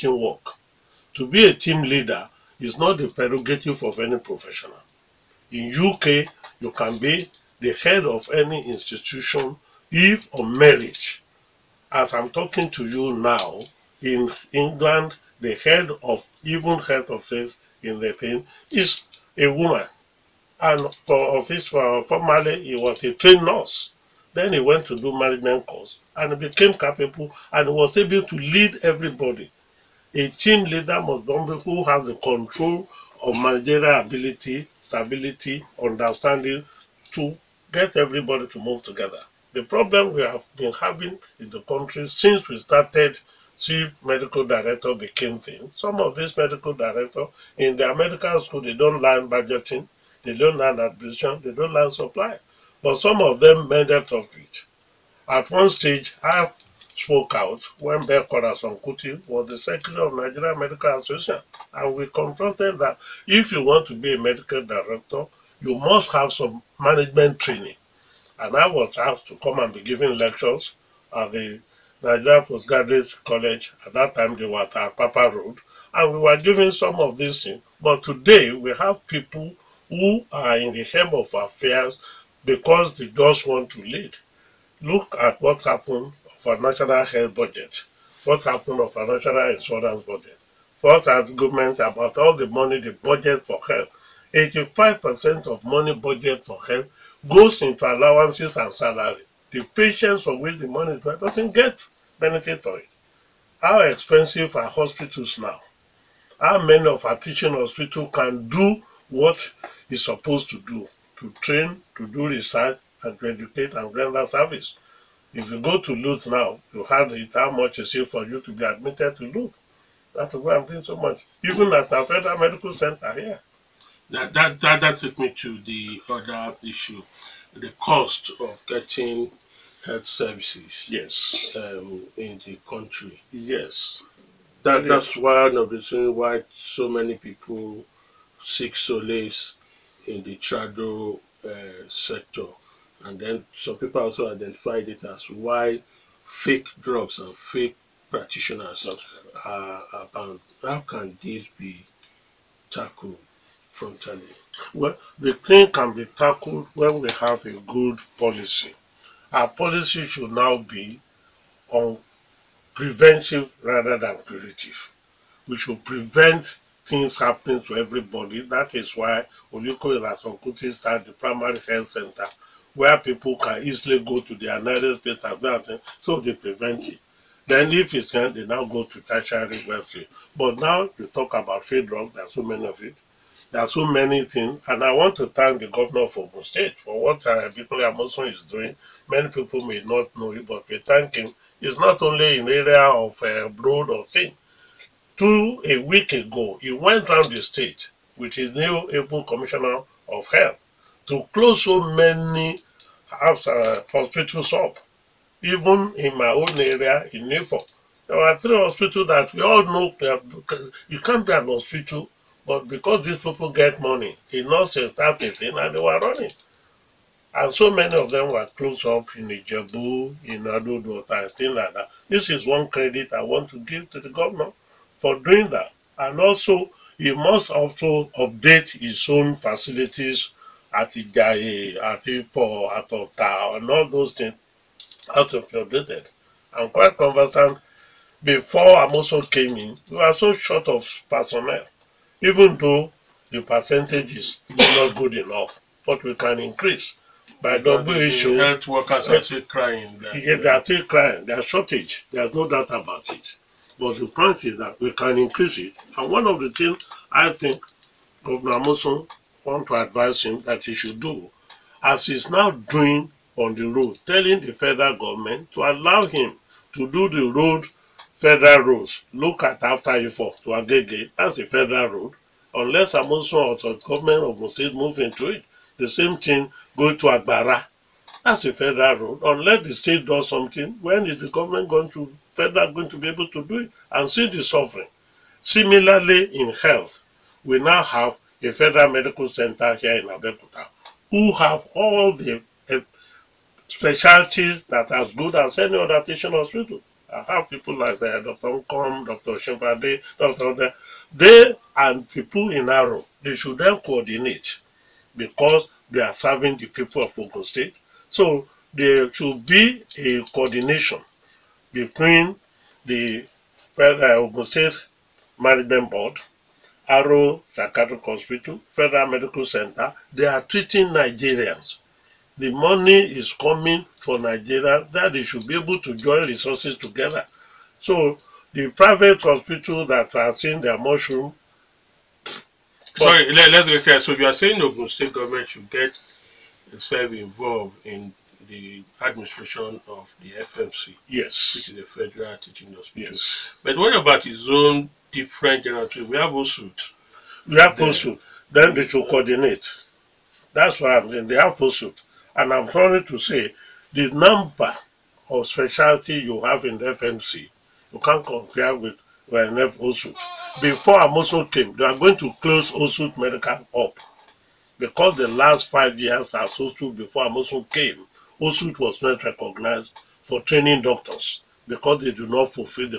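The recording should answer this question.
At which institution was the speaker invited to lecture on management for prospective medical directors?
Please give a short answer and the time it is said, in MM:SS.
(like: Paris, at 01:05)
Nigerian Postgraduate College, at 01:12.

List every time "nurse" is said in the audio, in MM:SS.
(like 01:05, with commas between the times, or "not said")
00:23, 03:34.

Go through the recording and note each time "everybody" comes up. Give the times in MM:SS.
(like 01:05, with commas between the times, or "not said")
00:28, 00:37, 02:47.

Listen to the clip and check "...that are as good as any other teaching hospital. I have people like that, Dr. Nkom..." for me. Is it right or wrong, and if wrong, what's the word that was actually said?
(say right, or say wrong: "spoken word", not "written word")
right.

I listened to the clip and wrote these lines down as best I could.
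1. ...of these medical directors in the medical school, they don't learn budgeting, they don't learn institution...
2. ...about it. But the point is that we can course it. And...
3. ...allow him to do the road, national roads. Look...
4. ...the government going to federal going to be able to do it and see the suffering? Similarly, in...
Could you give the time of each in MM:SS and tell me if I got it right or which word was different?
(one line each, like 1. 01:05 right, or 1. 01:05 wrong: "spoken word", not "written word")
1. 00:46 wrong: "administration", not "institution"
2. 04:12 wrong: "increase", not "course"
3. 04:25 wrong: "federal", not "national"
4. 04:41 right.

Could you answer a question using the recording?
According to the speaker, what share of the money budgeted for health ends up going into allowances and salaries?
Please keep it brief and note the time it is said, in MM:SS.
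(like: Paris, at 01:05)
85%, at 01:34.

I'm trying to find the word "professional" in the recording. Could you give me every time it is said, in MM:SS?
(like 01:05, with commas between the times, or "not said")
00:04.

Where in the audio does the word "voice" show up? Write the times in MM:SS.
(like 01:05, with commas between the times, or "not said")
not said.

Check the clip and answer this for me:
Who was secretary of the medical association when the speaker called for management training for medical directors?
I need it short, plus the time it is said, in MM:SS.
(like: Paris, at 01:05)
Beko Ransome-Kuti, at 00:58.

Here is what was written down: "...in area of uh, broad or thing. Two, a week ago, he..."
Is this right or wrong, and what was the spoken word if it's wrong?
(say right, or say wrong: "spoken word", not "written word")
right.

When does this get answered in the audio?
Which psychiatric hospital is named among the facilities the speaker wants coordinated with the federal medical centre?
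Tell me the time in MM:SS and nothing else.
05:16.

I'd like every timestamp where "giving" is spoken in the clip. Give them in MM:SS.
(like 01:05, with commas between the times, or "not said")
01:09, 01:16.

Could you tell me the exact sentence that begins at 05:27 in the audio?
So the private hospital that are seeing their mushroom.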